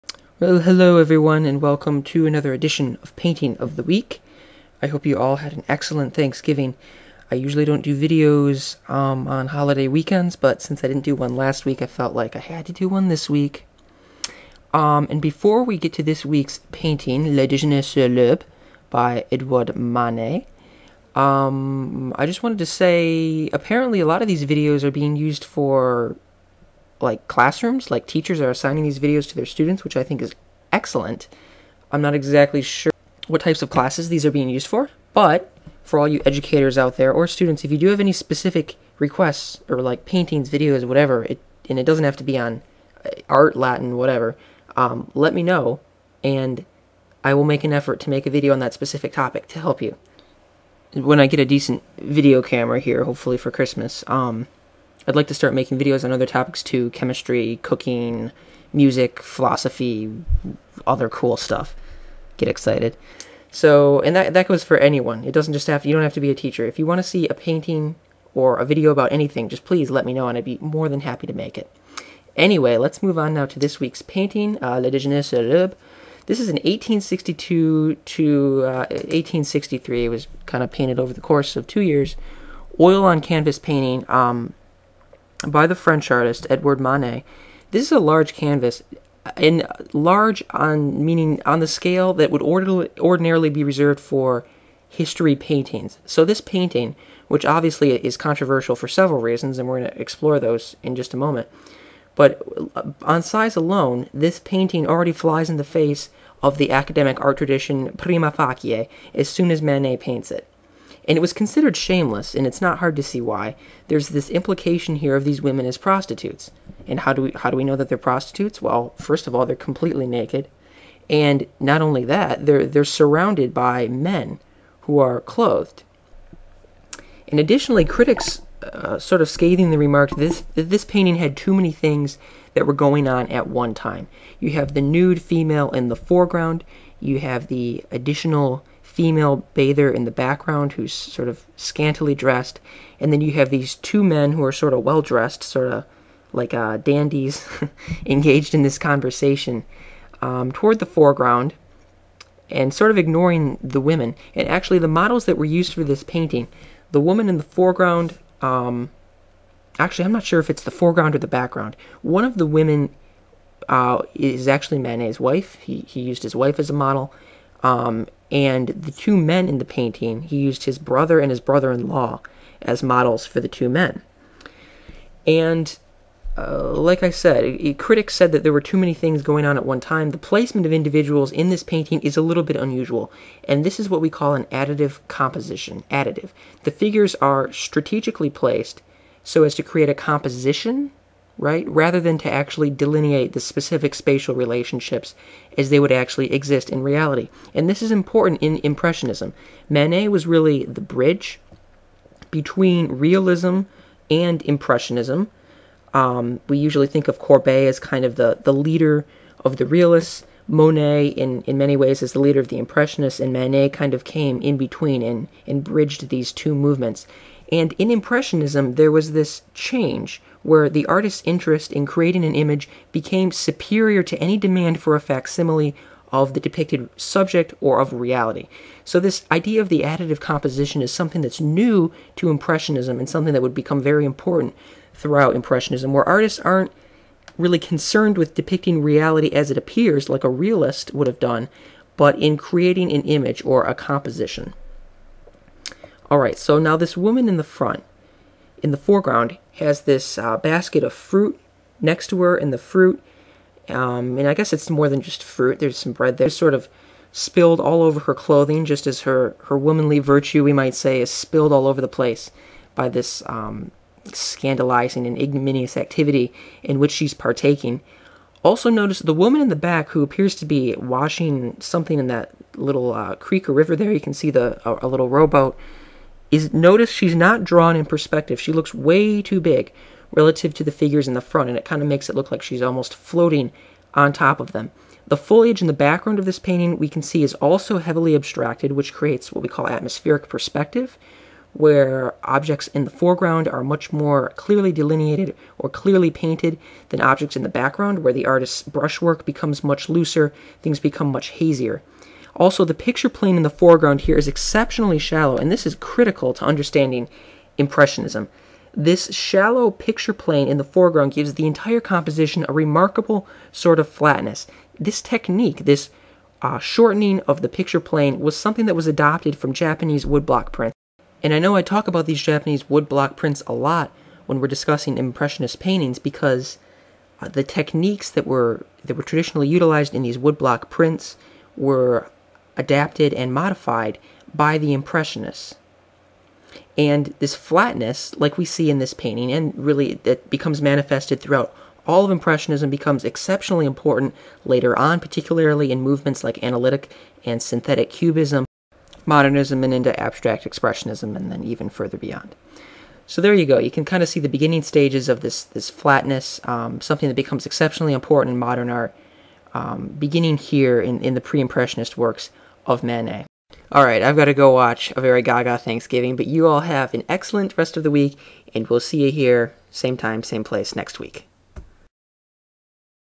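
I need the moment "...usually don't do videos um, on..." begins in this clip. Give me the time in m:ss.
0:07.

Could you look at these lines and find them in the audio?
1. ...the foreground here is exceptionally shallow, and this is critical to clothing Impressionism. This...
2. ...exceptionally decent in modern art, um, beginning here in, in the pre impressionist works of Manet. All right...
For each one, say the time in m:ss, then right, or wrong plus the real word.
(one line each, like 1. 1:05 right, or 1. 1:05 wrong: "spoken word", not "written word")
1. 5:03 wrong: "understanding", not "clothing"
2. 5:57 wrong: "important", not "decent".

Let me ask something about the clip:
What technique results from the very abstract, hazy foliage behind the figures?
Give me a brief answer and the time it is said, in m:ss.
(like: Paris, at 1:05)
Atmospheric perspective, at 4:49.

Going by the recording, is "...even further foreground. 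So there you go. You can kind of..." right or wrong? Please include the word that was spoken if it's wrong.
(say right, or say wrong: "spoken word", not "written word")
wrong: "beyond", not "foreground".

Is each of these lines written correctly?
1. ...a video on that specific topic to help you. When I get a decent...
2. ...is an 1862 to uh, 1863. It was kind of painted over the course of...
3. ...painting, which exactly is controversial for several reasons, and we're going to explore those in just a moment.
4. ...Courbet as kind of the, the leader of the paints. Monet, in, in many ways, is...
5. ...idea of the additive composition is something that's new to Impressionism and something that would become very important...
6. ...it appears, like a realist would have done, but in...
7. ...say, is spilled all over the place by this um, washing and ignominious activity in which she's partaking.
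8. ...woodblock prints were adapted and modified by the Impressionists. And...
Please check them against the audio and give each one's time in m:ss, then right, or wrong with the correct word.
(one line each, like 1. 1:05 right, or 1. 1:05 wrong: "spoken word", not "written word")
1. 0:48 right
2. 1:16 right
3. 1:36 wrong: "obviously", not "exactly"
4. 3:27 wrong: "realists", not "paints"
5. 3:49 right
6. 3:59 right
7. 4:20 wrong: "scandalizing", not "washing"
8. 5:30 right.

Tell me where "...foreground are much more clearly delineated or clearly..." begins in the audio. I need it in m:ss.
4:52.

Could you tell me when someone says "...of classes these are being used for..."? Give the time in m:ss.
0:33.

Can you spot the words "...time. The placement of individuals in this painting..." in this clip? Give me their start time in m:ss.
2:59.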